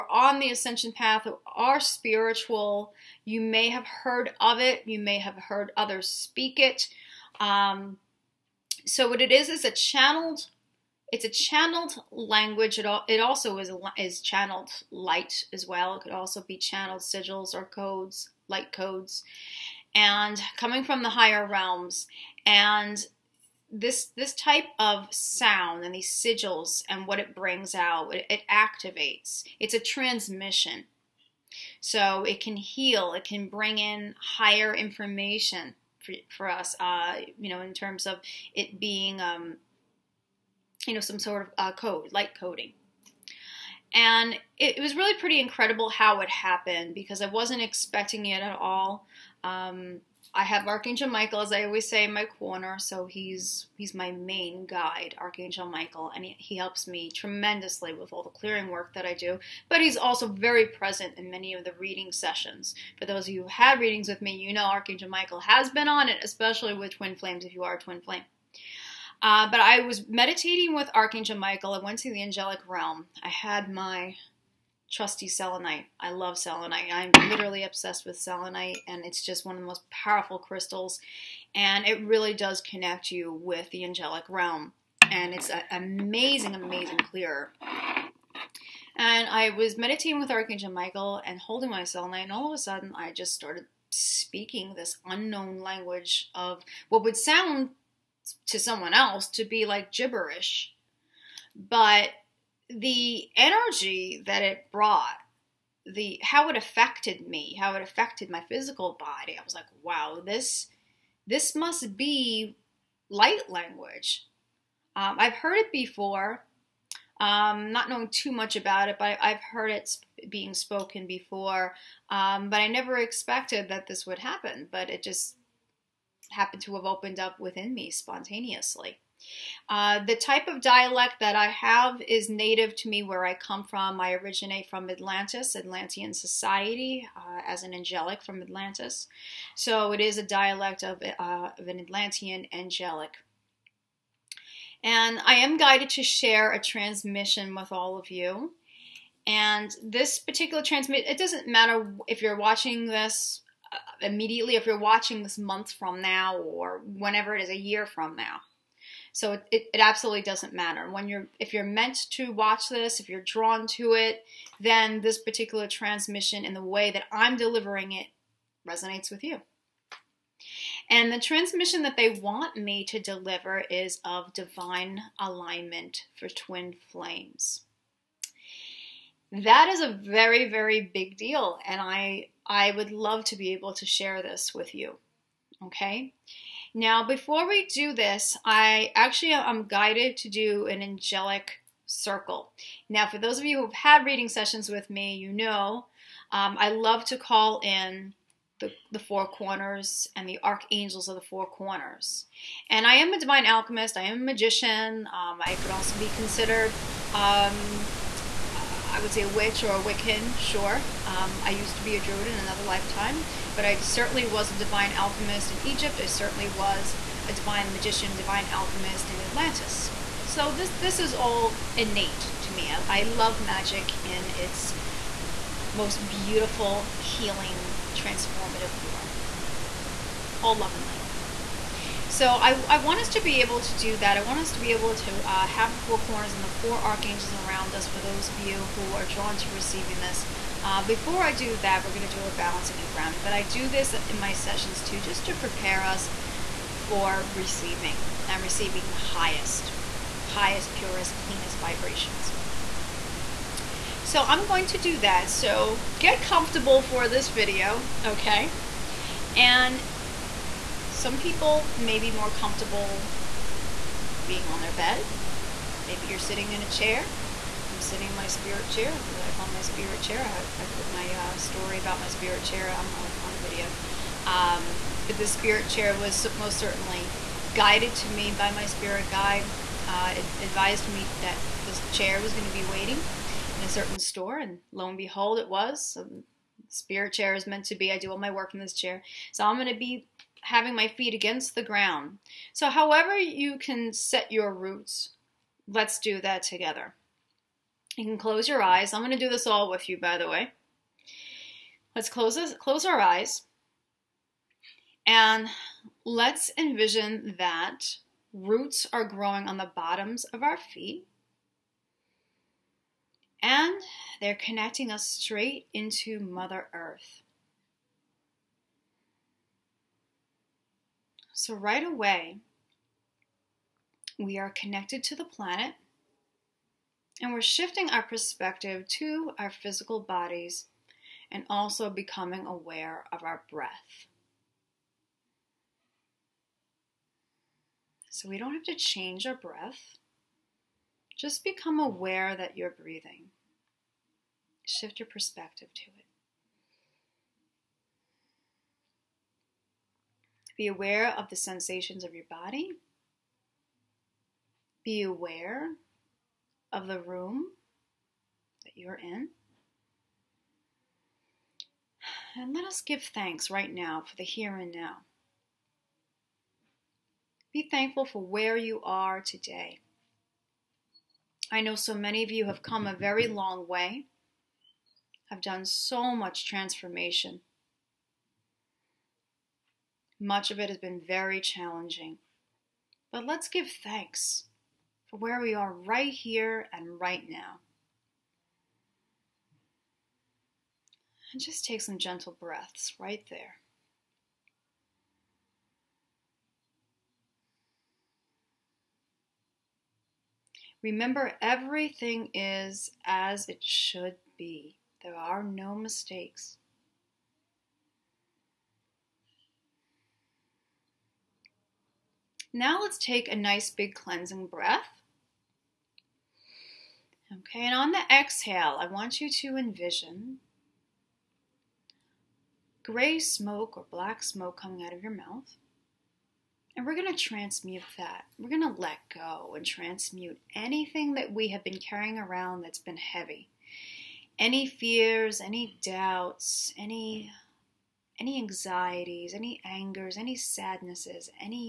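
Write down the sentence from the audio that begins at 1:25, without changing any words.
And it's an amazing, amazing clear.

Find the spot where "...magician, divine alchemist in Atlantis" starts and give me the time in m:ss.
3:37.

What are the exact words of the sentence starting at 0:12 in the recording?
It, all, it also is, is channeled light as well.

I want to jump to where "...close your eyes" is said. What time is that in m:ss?
4:58.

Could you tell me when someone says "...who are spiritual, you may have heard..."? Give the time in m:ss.
0:01.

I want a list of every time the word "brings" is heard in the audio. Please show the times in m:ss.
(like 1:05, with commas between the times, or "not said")
0:27, 0:33.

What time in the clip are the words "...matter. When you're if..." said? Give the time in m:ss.
2:40.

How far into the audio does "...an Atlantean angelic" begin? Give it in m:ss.
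2:21.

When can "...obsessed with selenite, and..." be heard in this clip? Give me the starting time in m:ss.
1:17.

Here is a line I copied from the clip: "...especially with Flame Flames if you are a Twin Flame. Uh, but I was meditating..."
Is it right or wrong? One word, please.
wrong.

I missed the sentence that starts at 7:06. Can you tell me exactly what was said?
And we're going to transmute that.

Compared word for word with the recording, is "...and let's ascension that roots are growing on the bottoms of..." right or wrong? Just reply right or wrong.
wrong.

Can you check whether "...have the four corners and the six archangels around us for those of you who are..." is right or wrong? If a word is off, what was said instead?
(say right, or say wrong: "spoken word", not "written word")
wrong: "four", not "six".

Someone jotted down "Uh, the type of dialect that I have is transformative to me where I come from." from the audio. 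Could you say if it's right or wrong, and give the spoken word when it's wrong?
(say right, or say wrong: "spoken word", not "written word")
wrong: "native", not "transformative".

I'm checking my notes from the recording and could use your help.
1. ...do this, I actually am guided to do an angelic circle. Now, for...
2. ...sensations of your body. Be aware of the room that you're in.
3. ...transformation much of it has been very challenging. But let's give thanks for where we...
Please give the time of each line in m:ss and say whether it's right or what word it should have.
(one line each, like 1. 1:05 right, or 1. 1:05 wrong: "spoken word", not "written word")
1. 3:07 right
2. 5:51 right
3. 6:16 right.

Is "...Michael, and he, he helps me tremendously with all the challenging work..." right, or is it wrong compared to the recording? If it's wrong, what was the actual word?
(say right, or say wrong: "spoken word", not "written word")
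wrong: "clearing", not "challenging".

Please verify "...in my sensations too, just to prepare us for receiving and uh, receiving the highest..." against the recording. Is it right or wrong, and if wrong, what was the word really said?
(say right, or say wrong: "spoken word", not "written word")
wrong: "sessions", not "sensations".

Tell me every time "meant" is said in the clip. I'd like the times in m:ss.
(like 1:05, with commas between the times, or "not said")
2:41, 4:47.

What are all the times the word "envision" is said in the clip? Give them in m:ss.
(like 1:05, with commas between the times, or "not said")
5:06, 6:59.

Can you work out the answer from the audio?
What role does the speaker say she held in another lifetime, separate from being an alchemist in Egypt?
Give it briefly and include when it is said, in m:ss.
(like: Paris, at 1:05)
Druid, at 3:31.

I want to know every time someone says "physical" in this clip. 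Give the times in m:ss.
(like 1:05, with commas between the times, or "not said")
1:48, 5:29.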